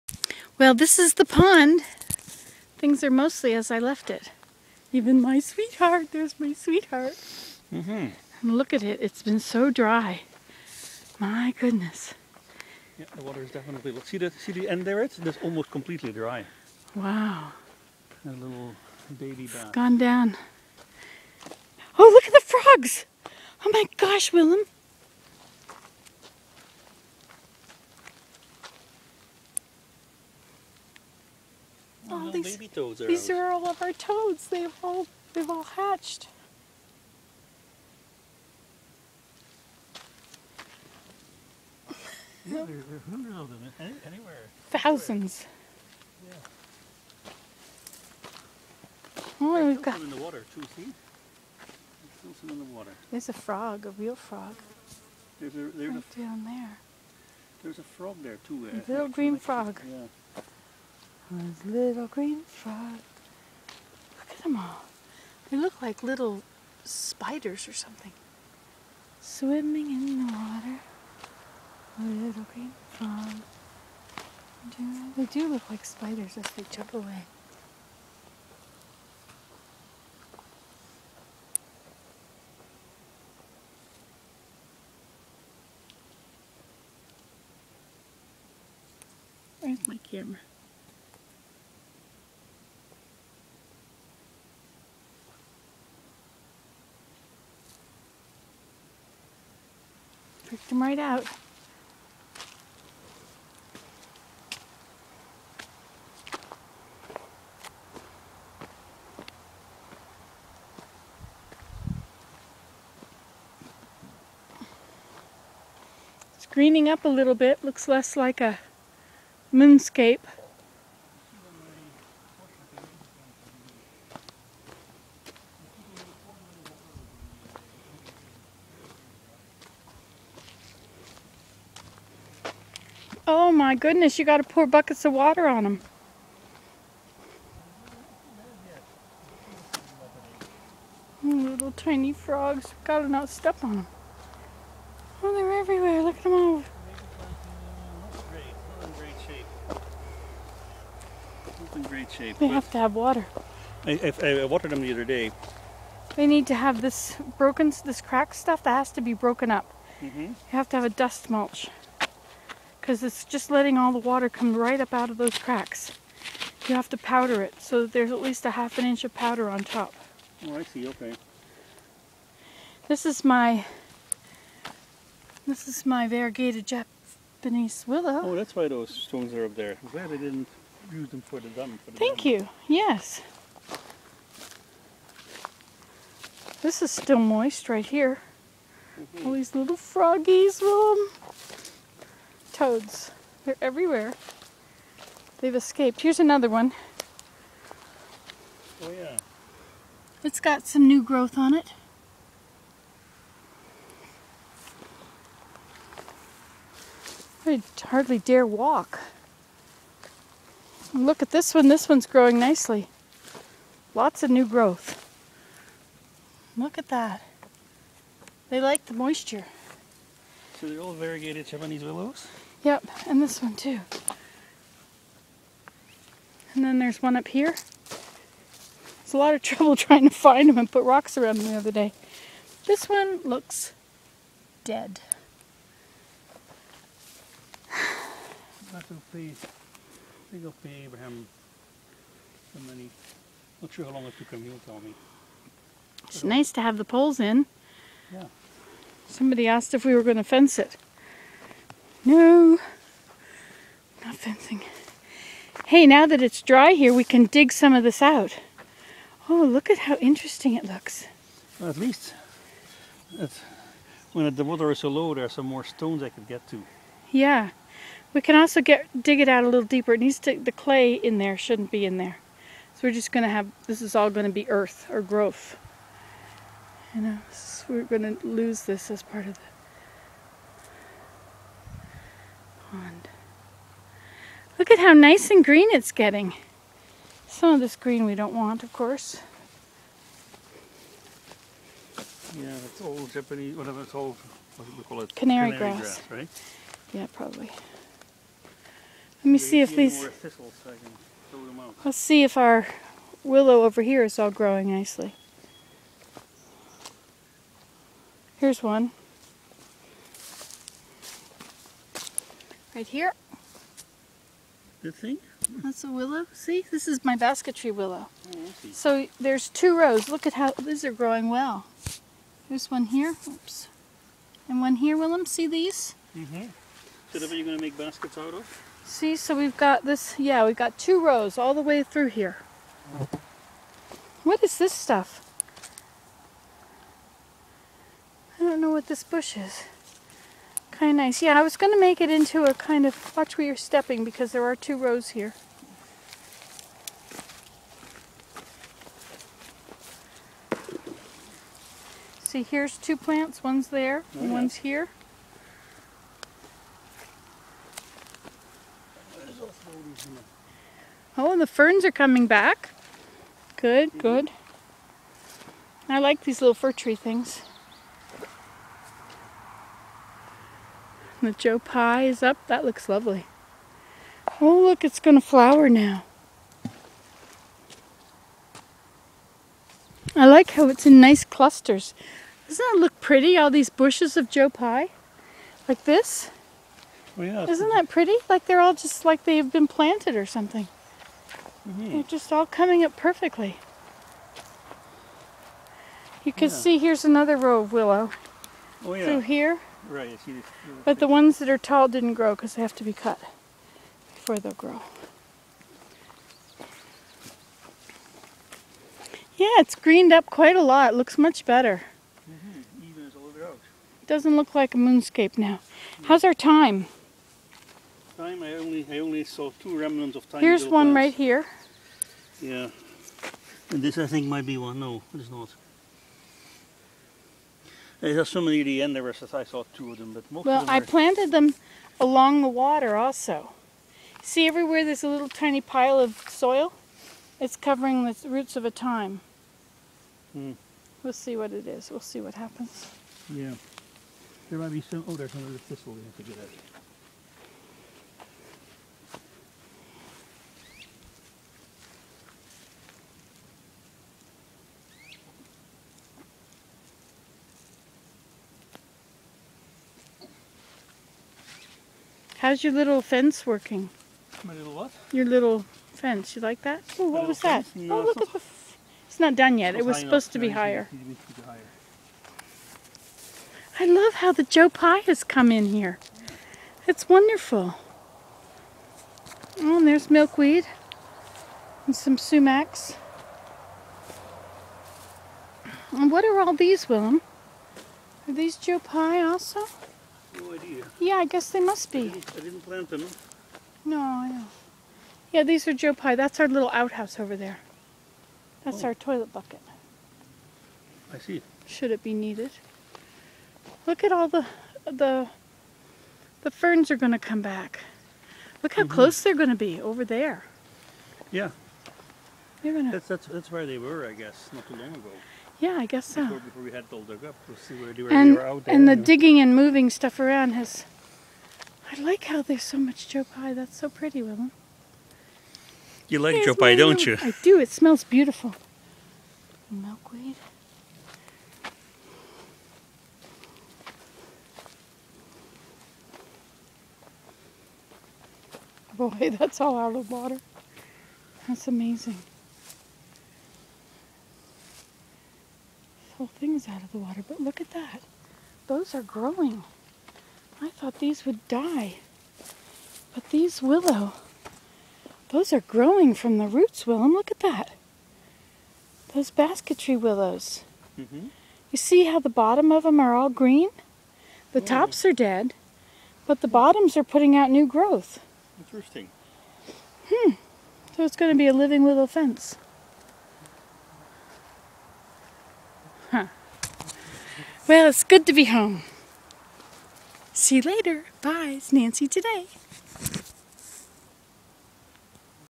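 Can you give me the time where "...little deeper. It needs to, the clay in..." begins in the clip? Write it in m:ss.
4:29.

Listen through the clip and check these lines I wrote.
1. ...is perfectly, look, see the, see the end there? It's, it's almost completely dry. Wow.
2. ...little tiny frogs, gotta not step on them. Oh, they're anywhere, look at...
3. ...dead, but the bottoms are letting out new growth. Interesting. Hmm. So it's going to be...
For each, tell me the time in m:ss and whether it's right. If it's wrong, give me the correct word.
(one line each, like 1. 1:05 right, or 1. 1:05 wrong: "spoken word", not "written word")
1. 0:13 wrong: "definitely", not "perfectly"
2. 2:21 wrong: "everywhere", not "anywhere"
3. 9:25 wrong: "putting", not "letting".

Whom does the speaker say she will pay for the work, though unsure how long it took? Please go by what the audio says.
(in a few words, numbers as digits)
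Abraham.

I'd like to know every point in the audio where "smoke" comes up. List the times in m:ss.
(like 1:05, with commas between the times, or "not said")
not said.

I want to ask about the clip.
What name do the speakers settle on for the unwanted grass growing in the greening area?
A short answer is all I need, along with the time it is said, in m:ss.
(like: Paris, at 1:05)
Canary grass, at 4:55.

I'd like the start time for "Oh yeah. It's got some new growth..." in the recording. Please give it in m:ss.
3:18.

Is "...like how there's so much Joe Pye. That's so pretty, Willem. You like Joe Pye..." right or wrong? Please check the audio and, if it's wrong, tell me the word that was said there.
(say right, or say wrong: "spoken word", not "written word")
right.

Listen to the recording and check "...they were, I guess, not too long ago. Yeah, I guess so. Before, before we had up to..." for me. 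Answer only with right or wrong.
right.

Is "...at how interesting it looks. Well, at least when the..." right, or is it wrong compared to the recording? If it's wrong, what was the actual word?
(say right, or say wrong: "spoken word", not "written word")
right.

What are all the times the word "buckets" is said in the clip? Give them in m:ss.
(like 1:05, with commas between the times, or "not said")
2:14, 8:19.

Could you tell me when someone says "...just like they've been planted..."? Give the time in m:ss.
6:28.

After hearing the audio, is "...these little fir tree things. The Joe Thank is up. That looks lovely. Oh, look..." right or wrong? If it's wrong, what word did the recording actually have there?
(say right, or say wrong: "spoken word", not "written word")
wrong: "Pye", not "Thank".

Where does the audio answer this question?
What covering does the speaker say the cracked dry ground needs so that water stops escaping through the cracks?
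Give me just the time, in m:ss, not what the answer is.
2:40.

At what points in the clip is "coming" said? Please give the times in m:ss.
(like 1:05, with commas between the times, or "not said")
6:01, 6:32.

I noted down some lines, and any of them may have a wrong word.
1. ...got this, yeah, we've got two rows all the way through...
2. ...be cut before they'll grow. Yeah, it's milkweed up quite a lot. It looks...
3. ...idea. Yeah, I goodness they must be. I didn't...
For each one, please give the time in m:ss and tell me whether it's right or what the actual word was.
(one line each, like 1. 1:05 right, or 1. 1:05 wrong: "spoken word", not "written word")
1. 5:29 right
2. 6:42 wrong: "greened", not "milkweed"
3. 8:10 wrong: "guess", not "goodness".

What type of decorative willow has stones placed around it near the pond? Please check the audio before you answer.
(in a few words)
variegated Japanese willow.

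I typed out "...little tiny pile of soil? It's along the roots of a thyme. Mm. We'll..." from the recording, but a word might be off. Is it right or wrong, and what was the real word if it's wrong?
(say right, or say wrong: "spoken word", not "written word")
wrong: "covering", not "along".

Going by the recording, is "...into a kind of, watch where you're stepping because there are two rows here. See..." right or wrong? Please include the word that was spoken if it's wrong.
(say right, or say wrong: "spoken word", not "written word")
right.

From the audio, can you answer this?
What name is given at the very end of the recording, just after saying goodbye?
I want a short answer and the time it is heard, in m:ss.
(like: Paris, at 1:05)
Nancy, at 9:41.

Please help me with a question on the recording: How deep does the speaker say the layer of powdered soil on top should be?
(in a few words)
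half an inch.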